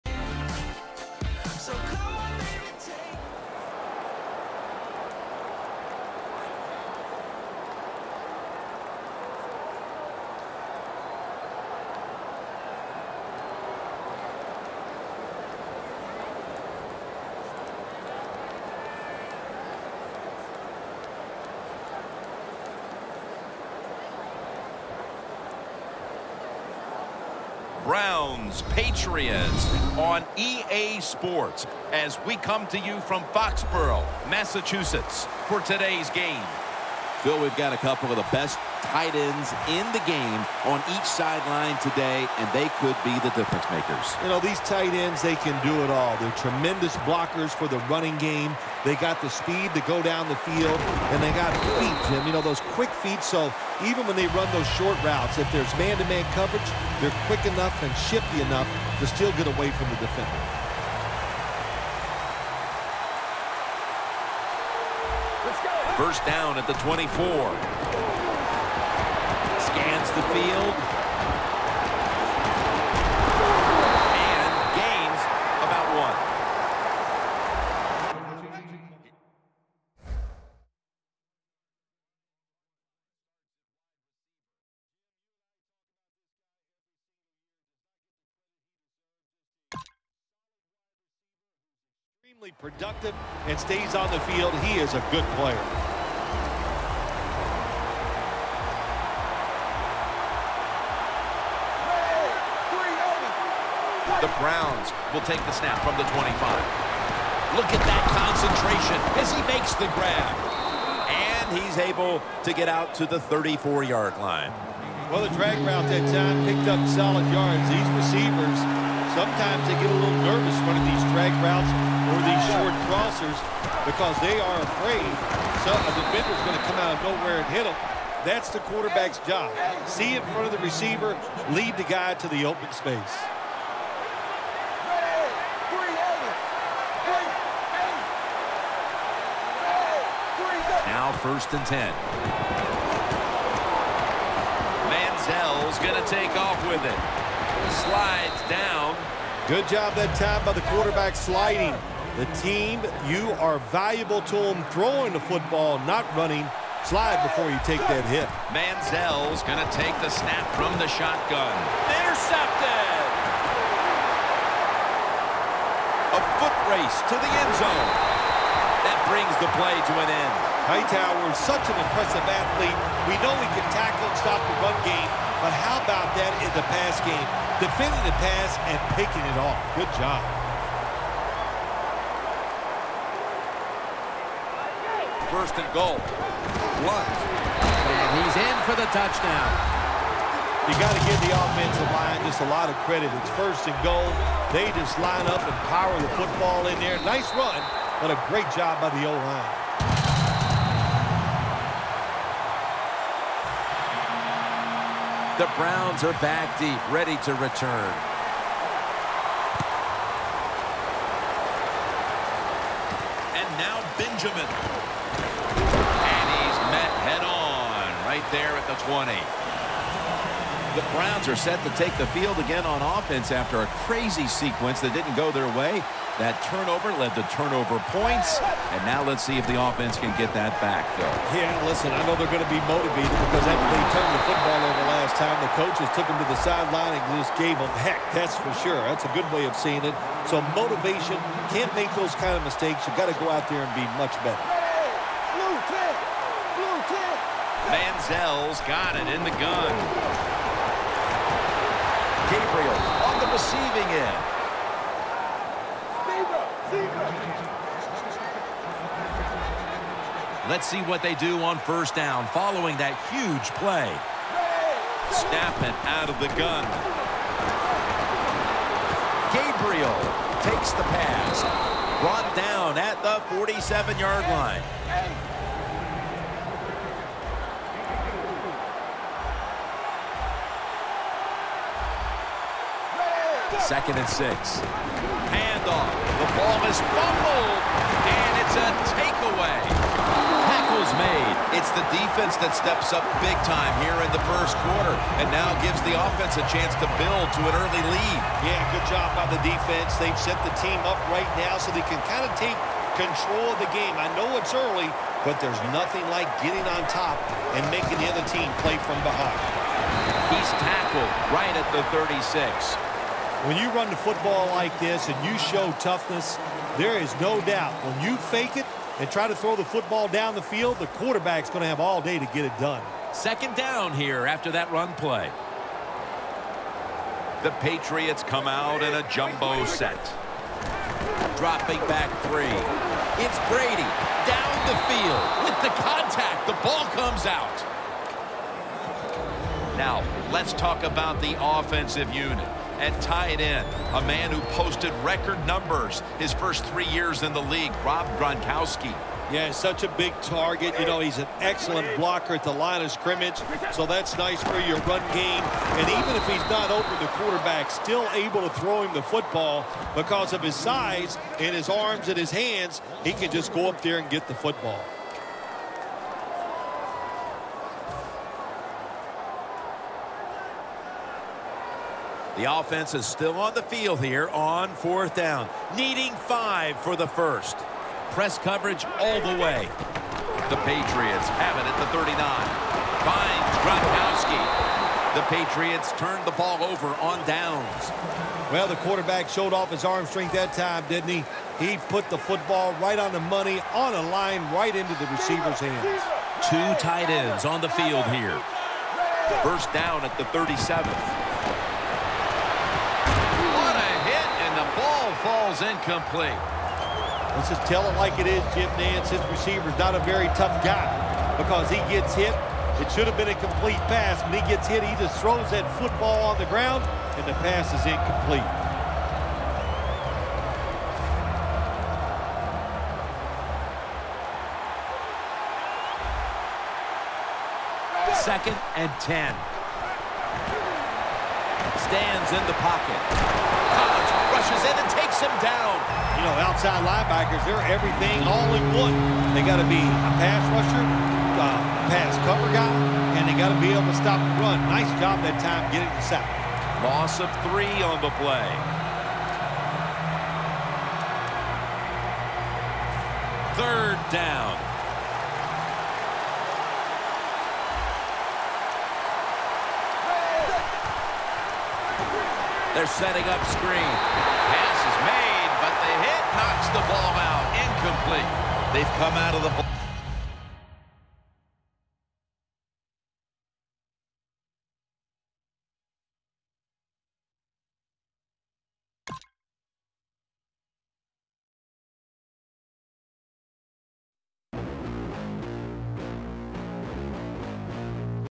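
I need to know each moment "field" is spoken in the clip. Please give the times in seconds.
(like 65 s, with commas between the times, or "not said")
50 s, 70 s, 94 s, 222 s, 320 s, 334 s, 373 s, 397 s.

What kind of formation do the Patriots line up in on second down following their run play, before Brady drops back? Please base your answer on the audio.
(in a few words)
jumbo set.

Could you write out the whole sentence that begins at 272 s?
Brought down at the 47-yard line.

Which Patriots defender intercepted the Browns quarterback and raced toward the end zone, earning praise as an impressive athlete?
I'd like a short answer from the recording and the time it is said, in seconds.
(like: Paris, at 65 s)
Hightower, at 170 s.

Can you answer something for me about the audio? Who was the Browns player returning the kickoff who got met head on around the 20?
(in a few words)
Benjamin.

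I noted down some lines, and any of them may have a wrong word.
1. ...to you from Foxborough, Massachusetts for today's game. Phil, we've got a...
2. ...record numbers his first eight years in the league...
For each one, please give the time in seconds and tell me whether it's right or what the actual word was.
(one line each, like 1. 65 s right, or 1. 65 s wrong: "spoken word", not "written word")
1. 32 s right
2. 345 s wrong: "three", not "eight".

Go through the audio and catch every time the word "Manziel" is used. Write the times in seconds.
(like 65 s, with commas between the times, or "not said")
144 s, 158 s, 247 s.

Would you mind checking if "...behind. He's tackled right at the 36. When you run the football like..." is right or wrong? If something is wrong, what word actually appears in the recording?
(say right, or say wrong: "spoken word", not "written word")
right.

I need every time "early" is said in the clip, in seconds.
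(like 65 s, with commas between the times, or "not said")
297 s, 304 s.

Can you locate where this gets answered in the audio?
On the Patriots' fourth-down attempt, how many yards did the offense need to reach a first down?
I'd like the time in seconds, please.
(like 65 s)
376 s.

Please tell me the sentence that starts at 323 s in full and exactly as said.
Second down here after that run play.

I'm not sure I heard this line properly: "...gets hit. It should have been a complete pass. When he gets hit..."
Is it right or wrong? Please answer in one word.
right.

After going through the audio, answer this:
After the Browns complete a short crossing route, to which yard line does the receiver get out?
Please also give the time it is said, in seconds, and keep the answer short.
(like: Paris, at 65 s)
34, at 113 s.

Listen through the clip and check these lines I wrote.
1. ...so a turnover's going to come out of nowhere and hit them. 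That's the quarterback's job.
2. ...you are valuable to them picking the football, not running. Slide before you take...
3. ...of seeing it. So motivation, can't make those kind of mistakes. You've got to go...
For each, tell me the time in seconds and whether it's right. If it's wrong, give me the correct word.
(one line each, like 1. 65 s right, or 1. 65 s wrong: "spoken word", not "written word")
1. 125 s wrong: "defender", not "turnover"
2. 153 s wrong: "throwing", not "picking"
3. 239 s right.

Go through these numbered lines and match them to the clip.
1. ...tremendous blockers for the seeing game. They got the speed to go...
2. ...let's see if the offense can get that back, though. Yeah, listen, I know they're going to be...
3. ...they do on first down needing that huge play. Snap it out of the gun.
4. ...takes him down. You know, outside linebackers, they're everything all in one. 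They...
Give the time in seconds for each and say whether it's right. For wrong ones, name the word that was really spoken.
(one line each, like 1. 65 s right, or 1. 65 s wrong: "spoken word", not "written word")
1. 46 s wrong: "running", not "seeing"
2. 229 s right
3. 261 s wrong: "following", not "needing"
4. 434 s right.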